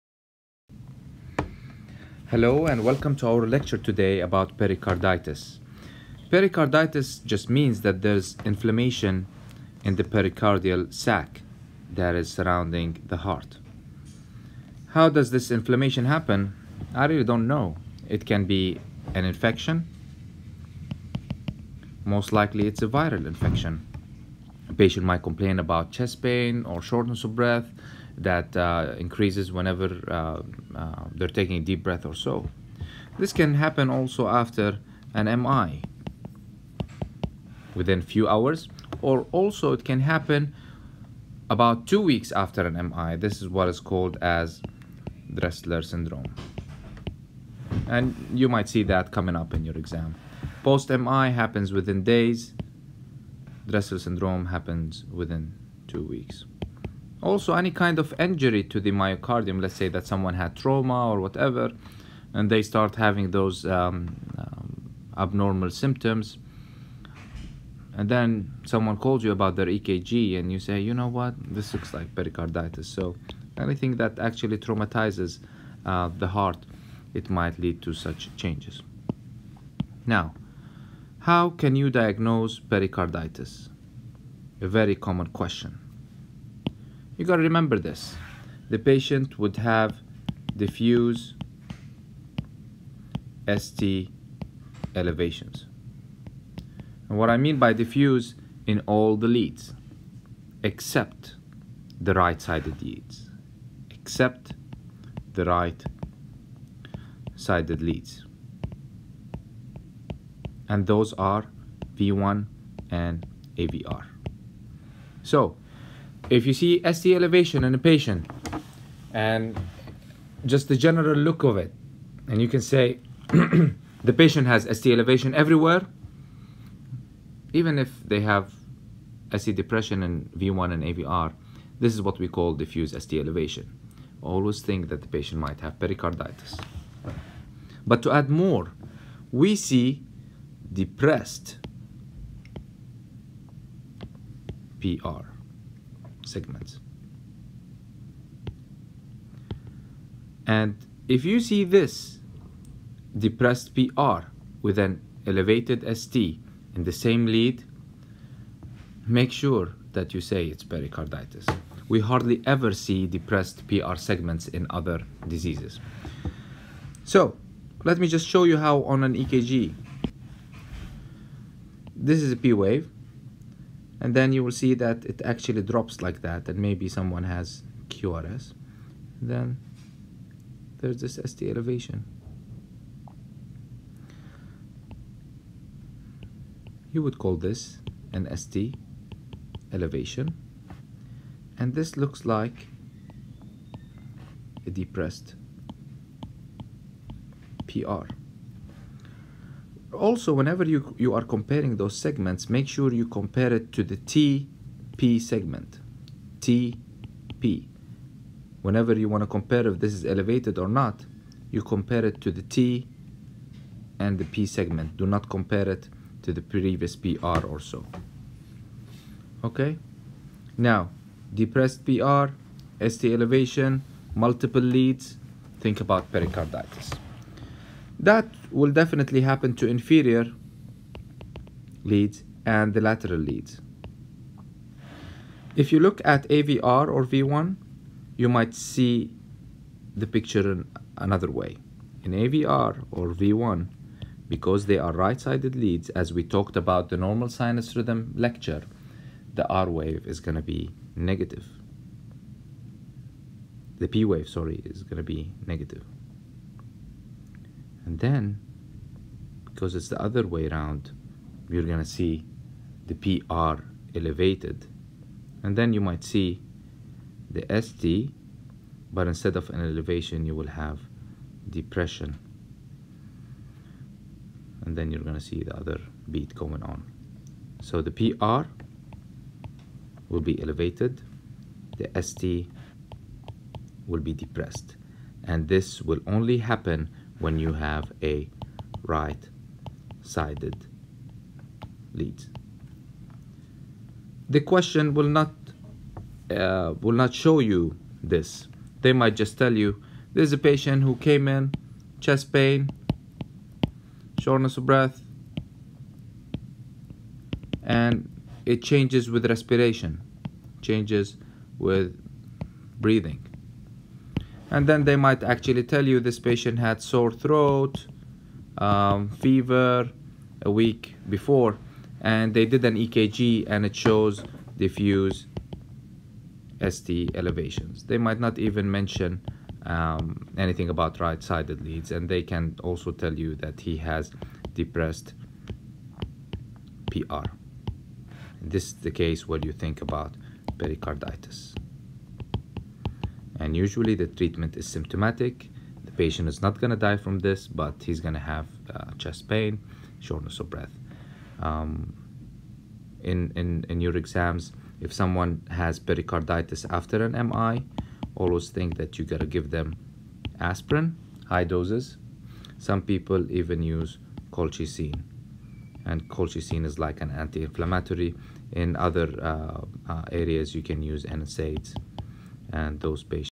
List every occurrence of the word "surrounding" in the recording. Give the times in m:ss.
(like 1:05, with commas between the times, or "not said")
0:12.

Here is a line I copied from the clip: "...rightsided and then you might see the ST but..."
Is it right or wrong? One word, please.
wrong.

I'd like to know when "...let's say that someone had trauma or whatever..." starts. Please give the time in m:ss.
0:59.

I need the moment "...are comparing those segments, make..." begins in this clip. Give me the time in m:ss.
3:21.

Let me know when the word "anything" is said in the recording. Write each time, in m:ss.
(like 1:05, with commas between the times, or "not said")
1:13, 5:30.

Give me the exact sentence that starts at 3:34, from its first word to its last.
Do not compare it to the previous PR or so.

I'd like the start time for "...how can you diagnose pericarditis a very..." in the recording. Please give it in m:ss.
1:21.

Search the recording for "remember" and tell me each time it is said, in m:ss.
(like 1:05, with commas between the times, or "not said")
1:27.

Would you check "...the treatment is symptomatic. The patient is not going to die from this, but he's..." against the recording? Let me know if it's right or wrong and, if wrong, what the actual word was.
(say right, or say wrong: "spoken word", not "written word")
right.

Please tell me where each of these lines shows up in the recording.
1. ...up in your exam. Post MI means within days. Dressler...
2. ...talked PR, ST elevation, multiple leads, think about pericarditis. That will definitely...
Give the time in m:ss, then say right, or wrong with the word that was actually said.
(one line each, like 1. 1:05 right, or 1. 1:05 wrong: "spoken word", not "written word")
1. 0:49 wrong: "happens", not "means"
2. 3:41 wrong: "depressed", not "talked".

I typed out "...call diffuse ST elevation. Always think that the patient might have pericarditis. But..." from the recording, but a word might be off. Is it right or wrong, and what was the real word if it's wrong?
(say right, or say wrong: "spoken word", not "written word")
right.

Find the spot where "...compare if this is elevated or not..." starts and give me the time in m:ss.
3:29.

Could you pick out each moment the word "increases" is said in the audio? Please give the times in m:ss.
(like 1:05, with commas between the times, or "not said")
0:28.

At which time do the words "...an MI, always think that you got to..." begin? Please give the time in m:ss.
5:57.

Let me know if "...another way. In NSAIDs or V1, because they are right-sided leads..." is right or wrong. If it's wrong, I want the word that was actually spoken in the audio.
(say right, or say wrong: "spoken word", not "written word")
wrong: "AVR", not "NSAIDs".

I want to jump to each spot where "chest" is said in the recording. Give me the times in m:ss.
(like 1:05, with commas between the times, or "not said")
0:25, 5:01, 5:48.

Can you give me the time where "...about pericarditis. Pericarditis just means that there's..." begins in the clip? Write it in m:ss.
0:04.